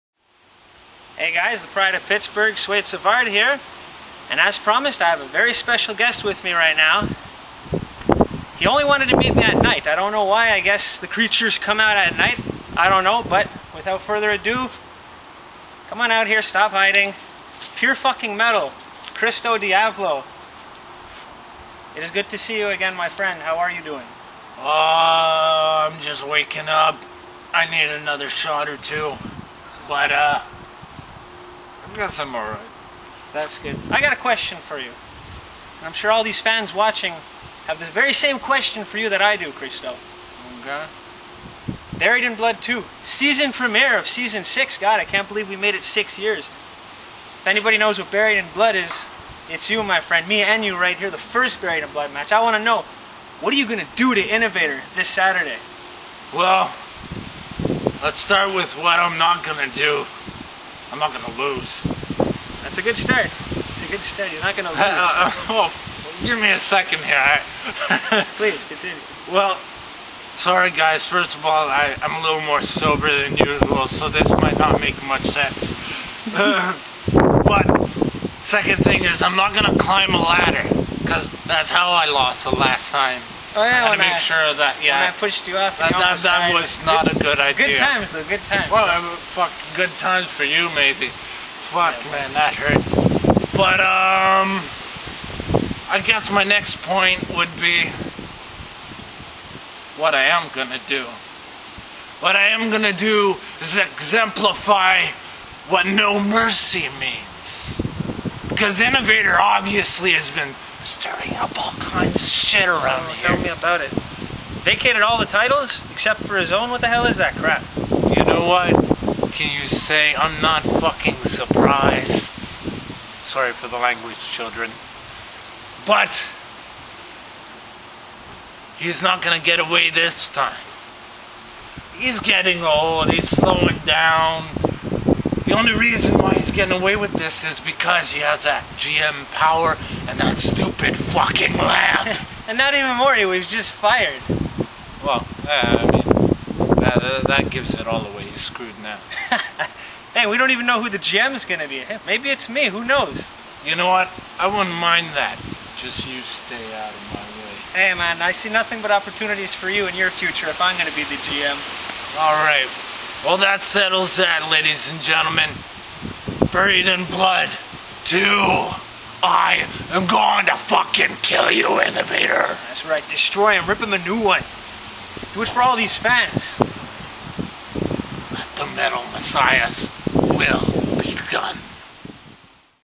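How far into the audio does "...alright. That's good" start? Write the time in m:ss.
0:32.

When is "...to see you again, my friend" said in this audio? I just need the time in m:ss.
0:22.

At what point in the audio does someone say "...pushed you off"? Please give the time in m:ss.
1:25.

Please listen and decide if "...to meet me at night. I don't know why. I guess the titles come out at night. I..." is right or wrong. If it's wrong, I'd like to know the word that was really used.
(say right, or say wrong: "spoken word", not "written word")
wrong: "creatures", not "titles".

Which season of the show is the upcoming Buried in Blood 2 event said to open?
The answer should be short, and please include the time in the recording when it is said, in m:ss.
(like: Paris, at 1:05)
Season 6, at 0:44.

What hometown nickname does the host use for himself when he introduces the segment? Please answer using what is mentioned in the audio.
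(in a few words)
The Pride of Pittsburgh.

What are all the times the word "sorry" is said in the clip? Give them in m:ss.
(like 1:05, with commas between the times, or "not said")
1:10, 2:03.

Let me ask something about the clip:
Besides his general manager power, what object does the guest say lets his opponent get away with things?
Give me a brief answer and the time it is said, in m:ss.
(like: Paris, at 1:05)
Lamp, at 2:21.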